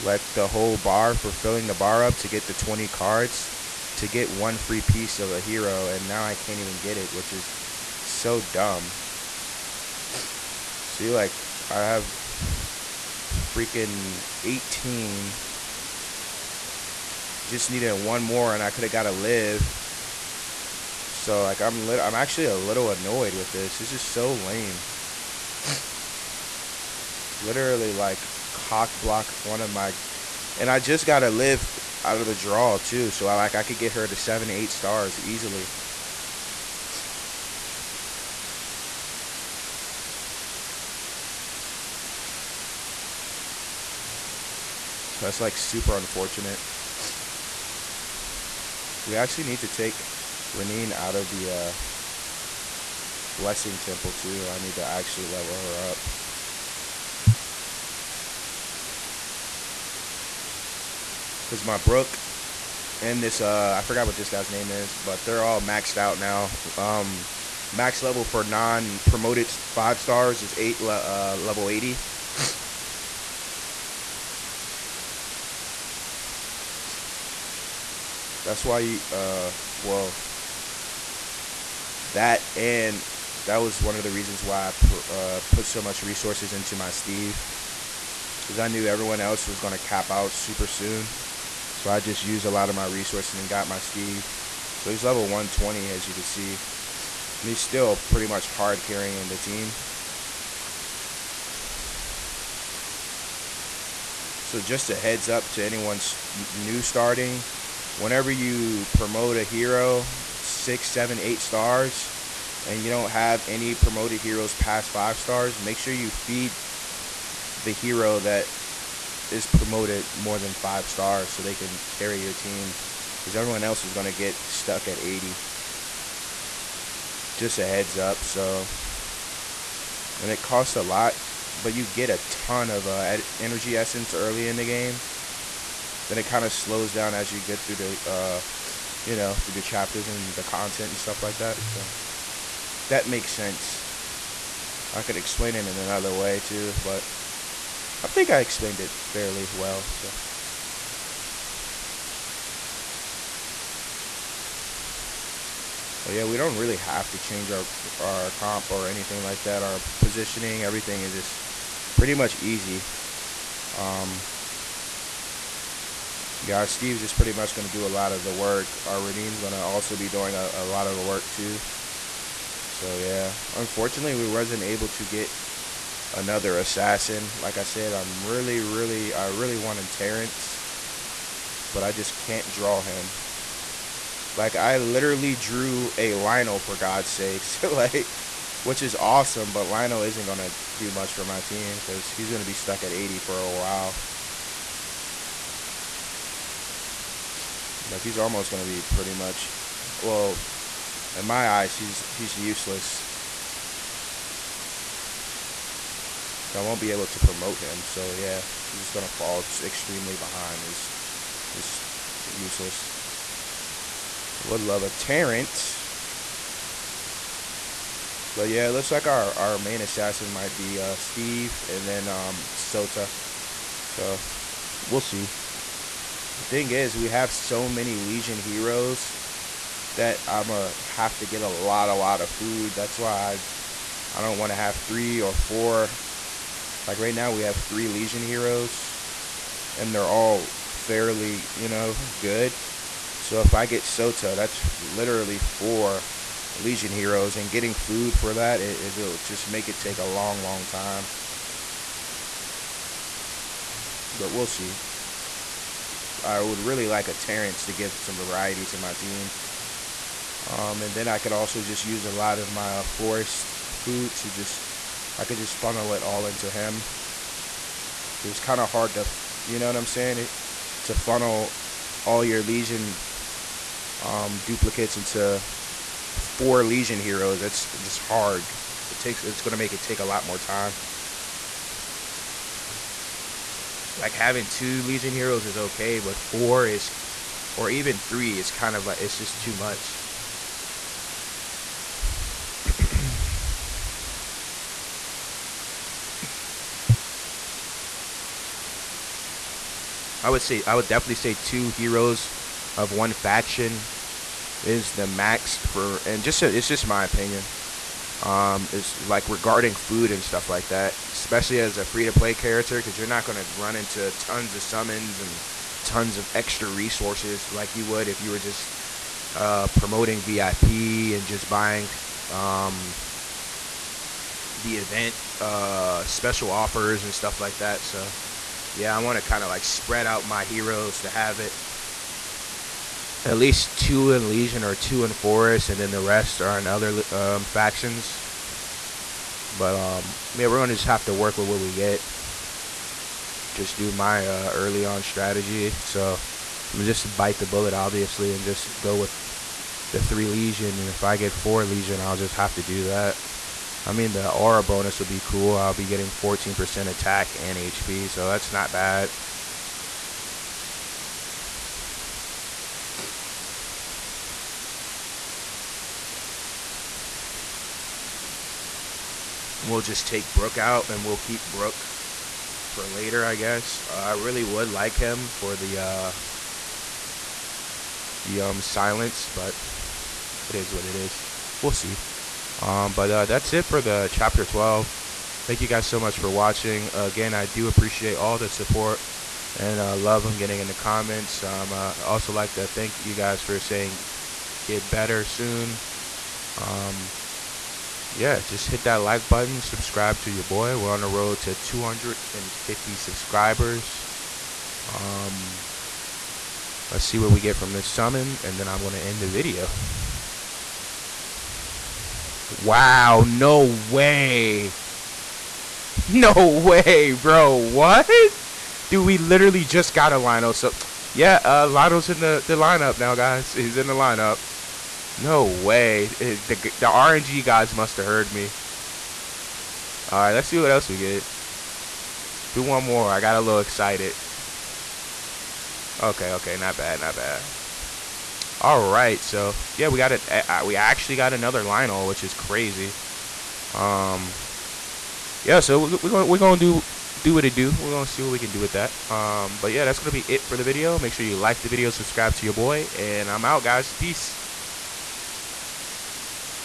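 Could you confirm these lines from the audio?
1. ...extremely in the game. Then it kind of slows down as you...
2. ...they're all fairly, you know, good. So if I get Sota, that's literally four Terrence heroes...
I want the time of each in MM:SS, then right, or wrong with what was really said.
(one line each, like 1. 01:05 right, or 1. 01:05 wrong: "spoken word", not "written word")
1. 02:14 wrong: "early", not "extremely"
2. 03:59 wrong: "Legion", not "Terrence".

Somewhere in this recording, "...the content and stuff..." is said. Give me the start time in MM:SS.
02:20.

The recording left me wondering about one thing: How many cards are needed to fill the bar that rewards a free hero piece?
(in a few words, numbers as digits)
20.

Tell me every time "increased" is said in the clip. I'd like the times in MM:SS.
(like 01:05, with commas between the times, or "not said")
not said.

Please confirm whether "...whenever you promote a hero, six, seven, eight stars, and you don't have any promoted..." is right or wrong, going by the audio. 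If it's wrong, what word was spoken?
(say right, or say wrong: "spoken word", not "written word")
right.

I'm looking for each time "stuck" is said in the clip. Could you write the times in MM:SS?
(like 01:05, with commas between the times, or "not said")
02:04, 03:12.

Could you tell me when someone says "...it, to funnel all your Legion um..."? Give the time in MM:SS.
04:30.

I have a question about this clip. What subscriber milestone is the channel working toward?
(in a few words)
250 subscribers.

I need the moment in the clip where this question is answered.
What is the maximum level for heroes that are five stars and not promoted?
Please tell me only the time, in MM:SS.
01:11.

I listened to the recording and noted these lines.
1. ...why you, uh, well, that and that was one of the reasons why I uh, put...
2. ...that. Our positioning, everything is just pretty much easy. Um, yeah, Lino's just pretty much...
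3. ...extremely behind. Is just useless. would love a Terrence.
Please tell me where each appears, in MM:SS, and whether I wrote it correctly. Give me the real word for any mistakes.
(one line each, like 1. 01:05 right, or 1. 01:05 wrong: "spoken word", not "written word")
1. 01:18 right
2. 02:39 wrong: "Steve", not "Lino"
3. 03:29 right.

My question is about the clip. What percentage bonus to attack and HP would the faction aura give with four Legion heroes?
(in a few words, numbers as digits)
14%.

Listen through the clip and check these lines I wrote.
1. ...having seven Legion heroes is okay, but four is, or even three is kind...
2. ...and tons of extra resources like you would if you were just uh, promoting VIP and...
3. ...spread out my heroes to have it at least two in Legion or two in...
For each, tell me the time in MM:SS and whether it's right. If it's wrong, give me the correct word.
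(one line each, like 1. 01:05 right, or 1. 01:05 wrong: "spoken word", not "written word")
1. 04:44 wrong: "two", not "seven"
2. 05:15 right
3. 05:29 right.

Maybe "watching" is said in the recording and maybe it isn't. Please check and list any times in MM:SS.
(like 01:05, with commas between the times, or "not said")
06:26.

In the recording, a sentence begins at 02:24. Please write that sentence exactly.
I could explain it in another way too, but I think I explained it fairly well, so.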